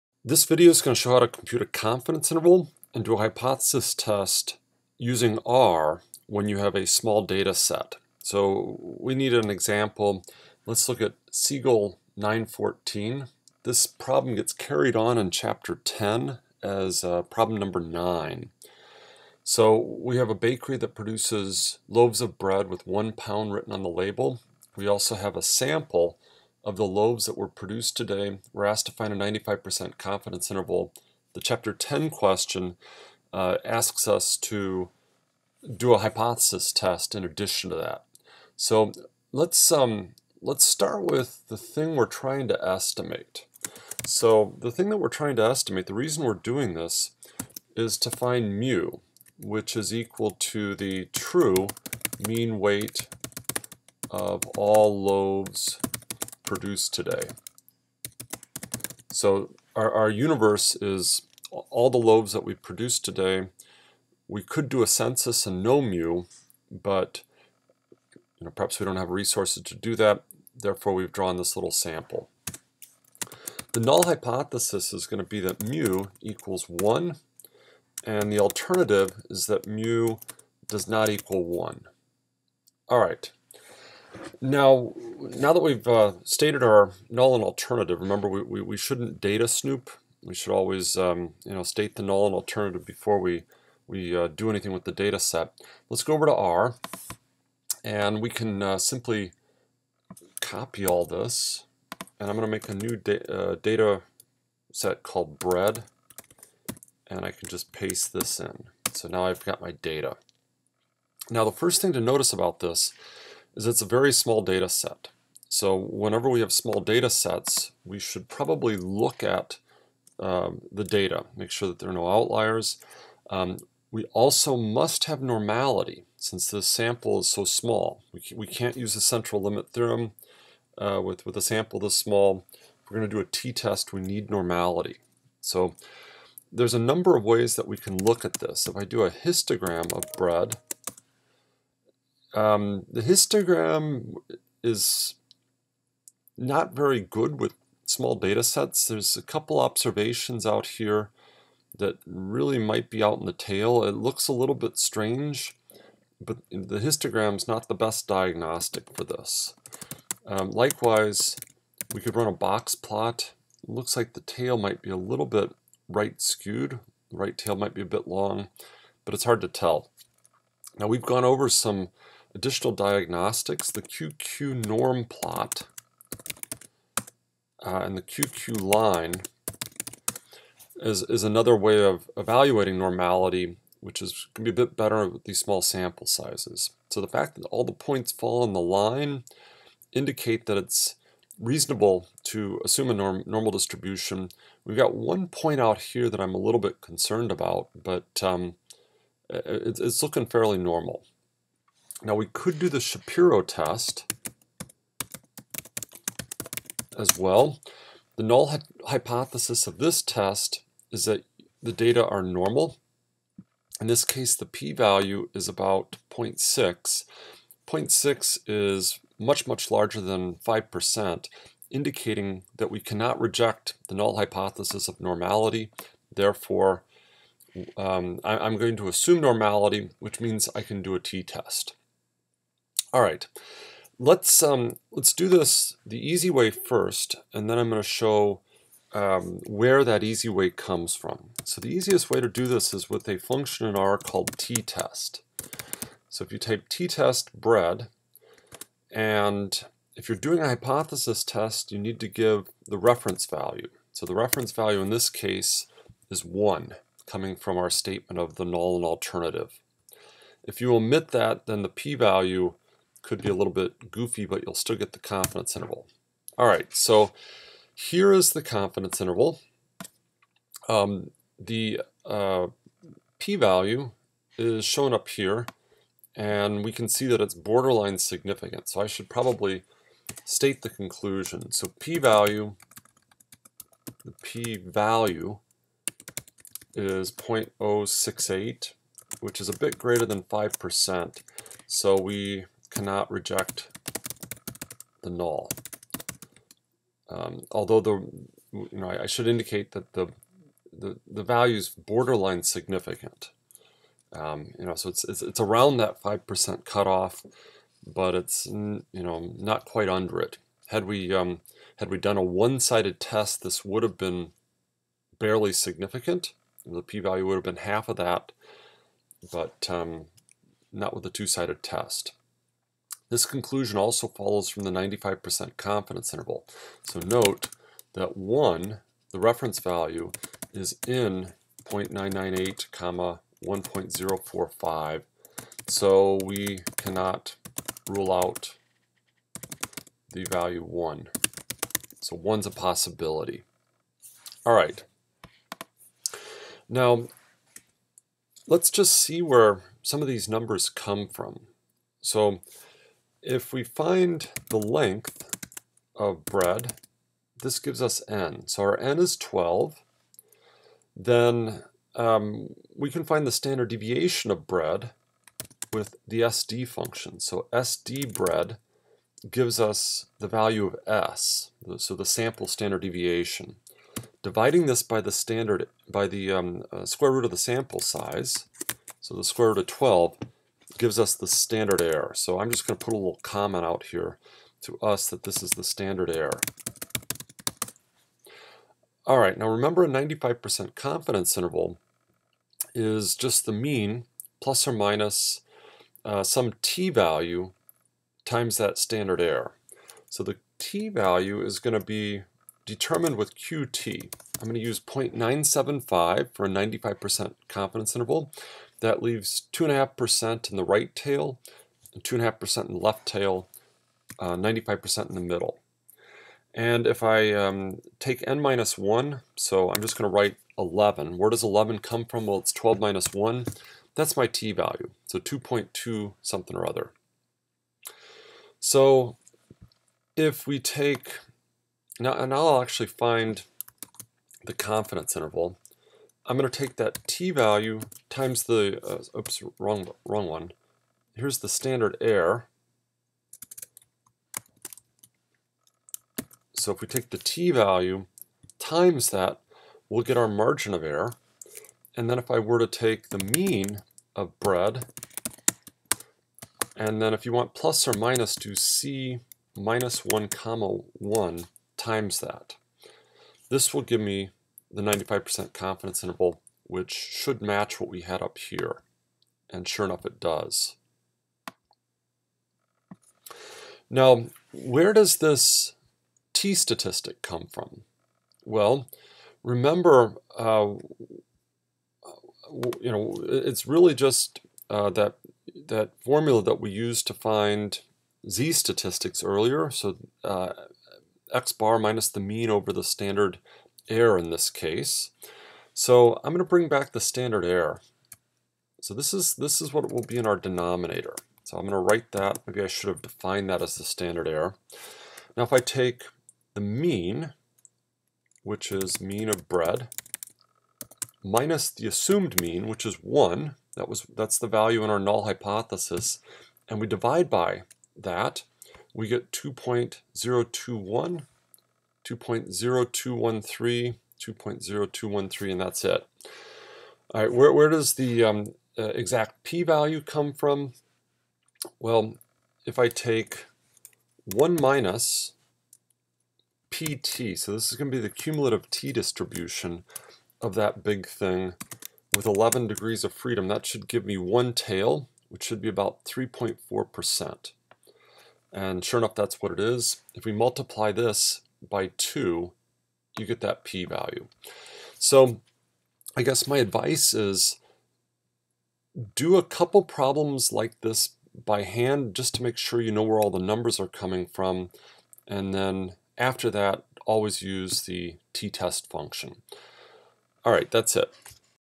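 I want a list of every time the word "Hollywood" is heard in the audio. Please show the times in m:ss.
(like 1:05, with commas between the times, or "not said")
not said.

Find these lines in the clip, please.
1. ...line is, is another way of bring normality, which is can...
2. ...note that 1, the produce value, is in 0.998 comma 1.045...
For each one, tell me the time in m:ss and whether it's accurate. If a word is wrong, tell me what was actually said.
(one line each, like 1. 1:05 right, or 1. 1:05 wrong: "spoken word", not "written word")
1. 2:58 wrong: "evaluating", not "bring"
2. 5:27 wrong: "reference", not "produce".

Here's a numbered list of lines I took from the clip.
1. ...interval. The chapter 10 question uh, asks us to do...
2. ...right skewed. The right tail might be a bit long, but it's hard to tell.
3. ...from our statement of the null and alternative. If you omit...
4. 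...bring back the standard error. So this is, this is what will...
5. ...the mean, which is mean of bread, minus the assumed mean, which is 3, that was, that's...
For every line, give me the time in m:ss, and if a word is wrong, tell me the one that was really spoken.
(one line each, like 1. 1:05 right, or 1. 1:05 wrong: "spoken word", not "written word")
1. 0:30 right
2. 2:45 right
3. 4:17 right
4. 8:16 right
5. 8:26 wrong: "1", not "3".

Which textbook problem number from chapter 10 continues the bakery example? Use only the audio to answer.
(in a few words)
9.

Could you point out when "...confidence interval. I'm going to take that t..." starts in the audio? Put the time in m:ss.
7:14.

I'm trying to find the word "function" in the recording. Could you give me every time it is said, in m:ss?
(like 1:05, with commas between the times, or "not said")
4:03, 6:06, 9:28.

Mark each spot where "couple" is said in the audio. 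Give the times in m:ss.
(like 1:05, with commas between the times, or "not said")
2:29, 9:19.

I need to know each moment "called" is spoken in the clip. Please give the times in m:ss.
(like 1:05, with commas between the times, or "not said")
1:45, 4:03.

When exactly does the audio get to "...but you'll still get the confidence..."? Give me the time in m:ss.
4:24.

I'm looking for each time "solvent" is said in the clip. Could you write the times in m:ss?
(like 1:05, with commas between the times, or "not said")
not said.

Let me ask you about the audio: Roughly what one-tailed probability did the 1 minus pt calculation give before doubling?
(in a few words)
3.4%.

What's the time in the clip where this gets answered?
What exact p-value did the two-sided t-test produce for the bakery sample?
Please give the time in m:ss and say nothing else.
4:47.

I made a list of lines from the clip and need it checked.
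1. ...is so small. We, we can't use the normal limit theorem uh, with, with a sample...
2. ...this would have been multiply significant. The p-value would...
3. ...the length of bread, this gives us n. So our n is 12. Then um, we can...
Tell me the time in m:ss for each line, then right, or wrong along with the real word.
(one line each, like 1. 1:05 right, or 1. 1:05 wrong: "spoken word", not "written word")
1. 2:07 wrong: "central", not "normal"
2. 5:13 wrong: "barely", not "multiply"
3. 5:54 right.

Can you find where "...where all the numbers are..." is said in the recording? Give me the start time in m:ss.
9:23.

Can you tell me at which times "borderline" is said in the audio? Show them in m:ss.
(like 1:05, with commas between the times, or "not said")
4:37, 5:01.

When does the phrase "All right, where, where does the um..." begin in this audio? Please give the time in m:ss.
8:47.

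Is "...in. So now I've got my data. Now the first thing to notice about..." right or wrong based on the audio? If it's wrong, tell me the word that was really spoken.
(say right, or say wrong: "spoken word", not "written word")
right.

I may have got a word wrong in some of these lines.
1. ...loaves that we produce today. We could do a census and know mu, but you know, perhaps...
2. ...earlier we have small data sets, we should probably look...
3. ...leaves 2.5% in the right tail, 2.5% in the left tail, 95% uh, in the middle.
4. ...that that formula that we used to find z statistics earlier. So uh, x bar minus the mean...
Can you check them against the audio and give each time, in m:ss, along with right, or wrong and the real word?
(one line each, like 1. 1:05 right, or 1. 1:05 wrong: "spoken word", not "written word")
1. 1:01 right
2. 1:55 wrong: "whenever", not "earlier"
3. 6:49 right
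4. 8:04 right.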